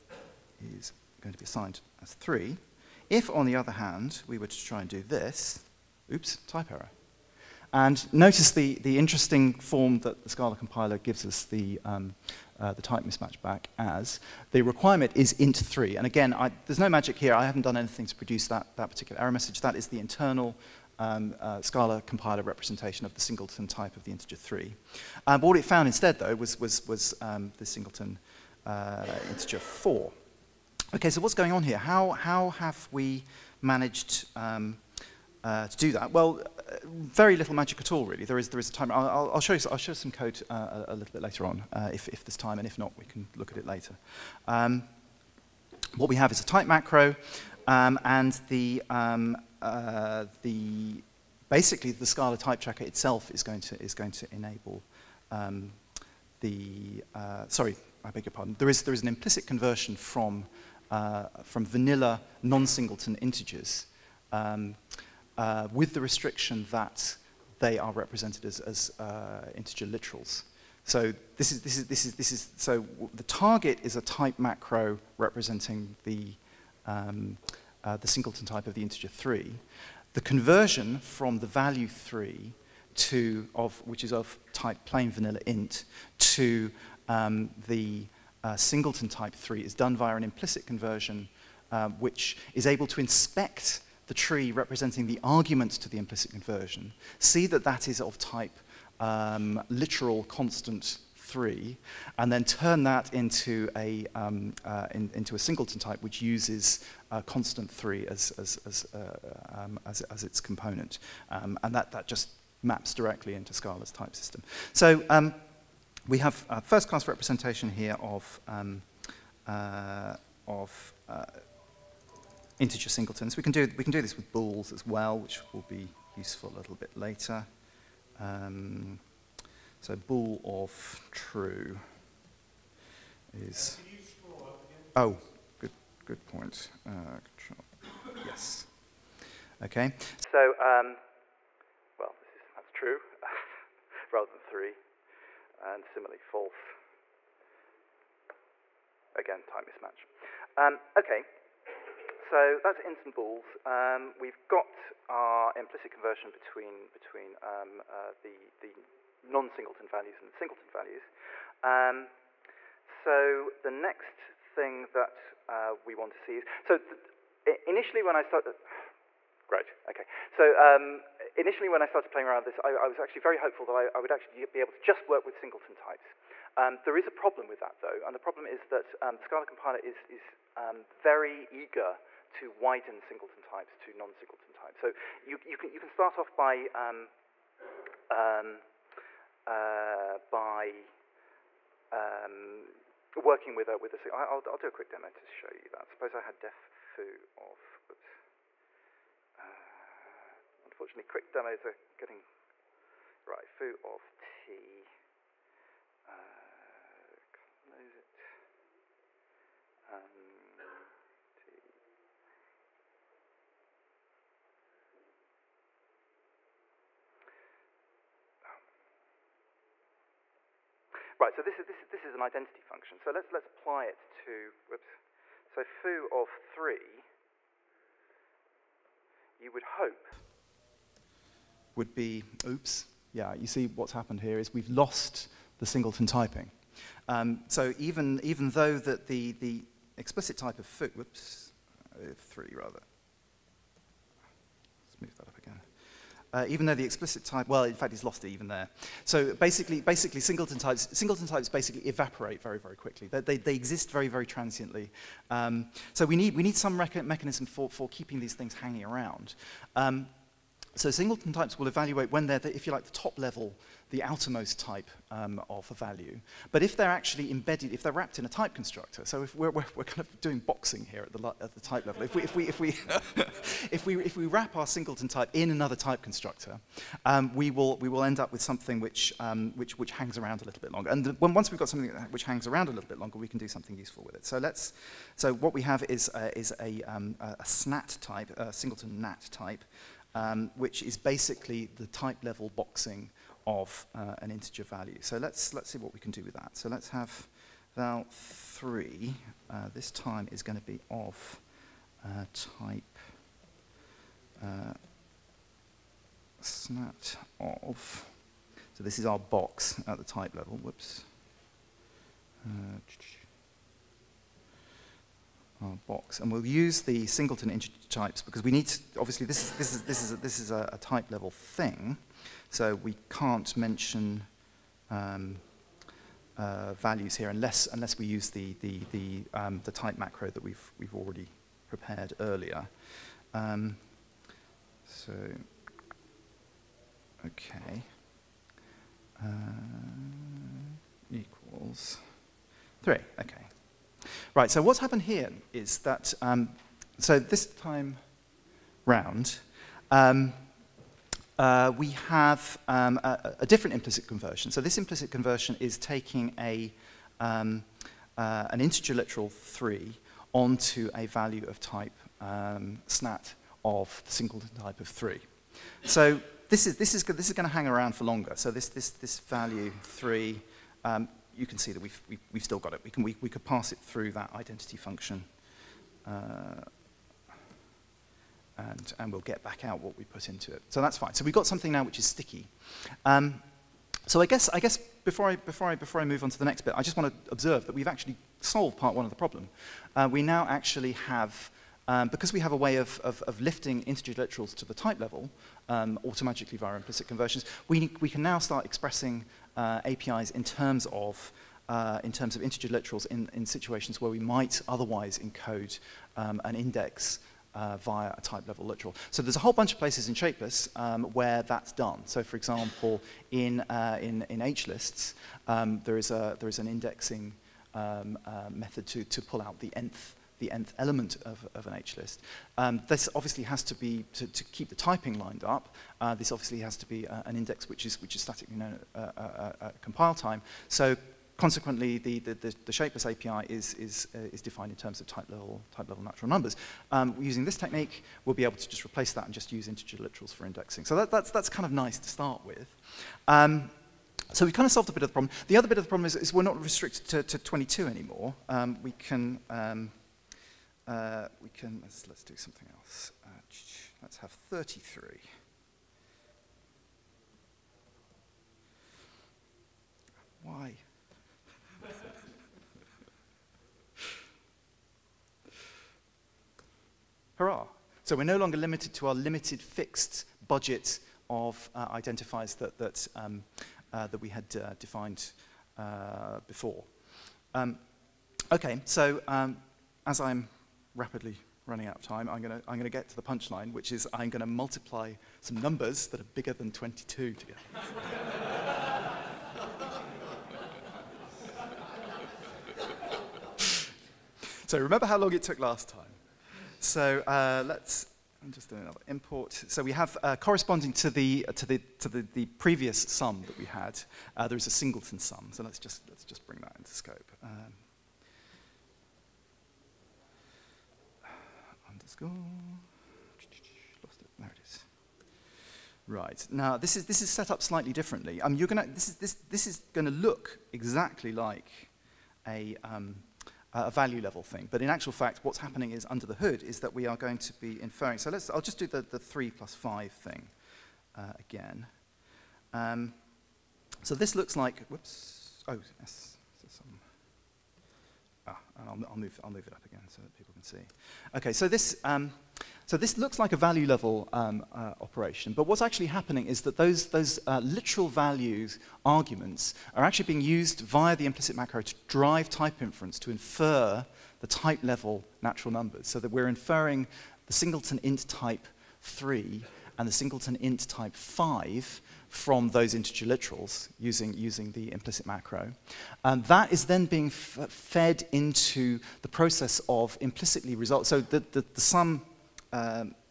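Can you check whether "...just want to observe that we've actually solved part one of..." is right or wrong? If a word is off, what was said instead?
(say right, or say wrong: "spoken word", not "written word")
right.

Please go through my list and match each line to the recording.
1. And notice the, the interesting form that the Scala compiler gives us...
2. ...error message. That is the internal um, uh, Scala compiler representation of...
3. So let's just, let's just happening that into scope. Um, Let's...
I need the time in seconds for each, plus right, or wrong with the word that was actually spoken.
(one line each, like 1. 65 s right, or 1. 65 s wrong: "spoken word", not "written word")
1. 7 s right
2. 19 s right
3. 505 s wrong: "bring", not "happening".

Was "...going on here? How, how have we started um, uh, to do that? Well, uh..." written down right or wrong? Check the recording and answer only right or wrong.
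wrong.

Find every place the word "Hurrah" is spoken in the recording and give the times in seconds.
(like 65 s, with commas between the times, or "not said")
467 s.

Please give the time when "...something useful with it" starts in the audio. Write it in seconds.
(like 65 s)
283 s.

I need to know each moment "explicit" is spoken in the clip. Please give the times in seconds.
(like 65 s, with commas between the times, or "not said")
239 s, 246 s.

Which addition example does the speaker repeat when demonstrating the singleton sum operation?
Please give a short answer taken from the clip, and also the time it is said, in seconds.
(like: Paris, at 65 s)
3 plus 5, at 529 s.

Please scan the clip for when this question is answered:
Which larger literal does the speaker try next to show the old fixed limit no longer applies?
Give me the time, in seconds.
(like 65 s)
454 s.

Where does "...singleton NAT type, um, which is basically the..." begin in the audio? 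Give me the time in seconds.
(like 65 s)
288 s.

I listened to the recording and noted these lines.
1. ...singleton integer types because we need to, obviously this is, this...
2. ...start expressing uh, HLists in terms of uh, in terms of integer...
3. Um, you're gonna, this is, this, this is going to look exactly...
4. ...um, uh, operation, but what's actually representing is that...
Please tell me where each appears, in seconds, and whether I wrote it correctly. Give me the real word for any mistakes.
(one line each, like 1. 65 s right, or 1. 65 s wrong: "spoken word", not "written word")
1. 317 s right
2. 398 s wrong: "APIs", not "HLists"
3. 518 s right
4. 544 s wrong: "happening", not "representing".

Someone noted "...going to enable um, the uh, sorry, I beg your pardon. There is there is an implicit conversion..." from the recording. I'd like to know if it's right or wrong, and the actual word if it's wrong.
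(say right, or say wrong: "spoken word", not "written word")
right.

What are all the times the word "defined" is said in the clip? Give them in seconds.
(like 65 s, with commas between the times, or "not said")
434 s, 474 s.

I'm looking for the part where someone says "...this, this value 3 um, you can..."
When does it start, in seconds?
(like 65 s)
368 s.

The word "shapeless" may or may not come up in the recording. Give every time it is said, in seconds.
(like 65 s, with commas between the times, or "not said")
410 s, 432 s.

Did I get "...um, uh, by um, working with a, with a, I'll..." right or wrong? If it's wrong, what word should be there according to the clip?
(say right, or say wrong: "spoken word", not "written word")
right.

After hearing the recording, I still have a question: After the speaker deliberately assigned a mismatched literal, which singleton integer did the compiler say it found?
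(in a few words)
4.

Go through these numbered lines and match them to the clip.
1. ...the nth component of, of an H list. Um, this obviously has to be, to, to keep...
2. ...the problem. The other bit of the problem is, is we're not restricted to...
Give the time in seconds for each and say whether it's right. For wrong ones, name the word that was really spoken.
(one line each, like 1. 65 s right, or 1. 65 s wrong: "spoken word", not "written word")
1. 420 s wrong: "element", not "component"
2. 445 s right.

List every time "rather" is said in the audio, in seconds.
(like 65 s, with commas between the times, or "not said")
144 s, 242 s.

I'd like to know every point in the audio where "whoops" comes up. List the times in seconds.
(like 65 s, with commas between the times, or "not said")
197 s, 224 s, 240 s, 310 s, 534 s.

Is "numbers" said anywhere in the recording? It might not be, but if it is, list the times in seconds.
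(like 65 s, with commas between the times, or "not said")
436 s, 485 s, 555 s.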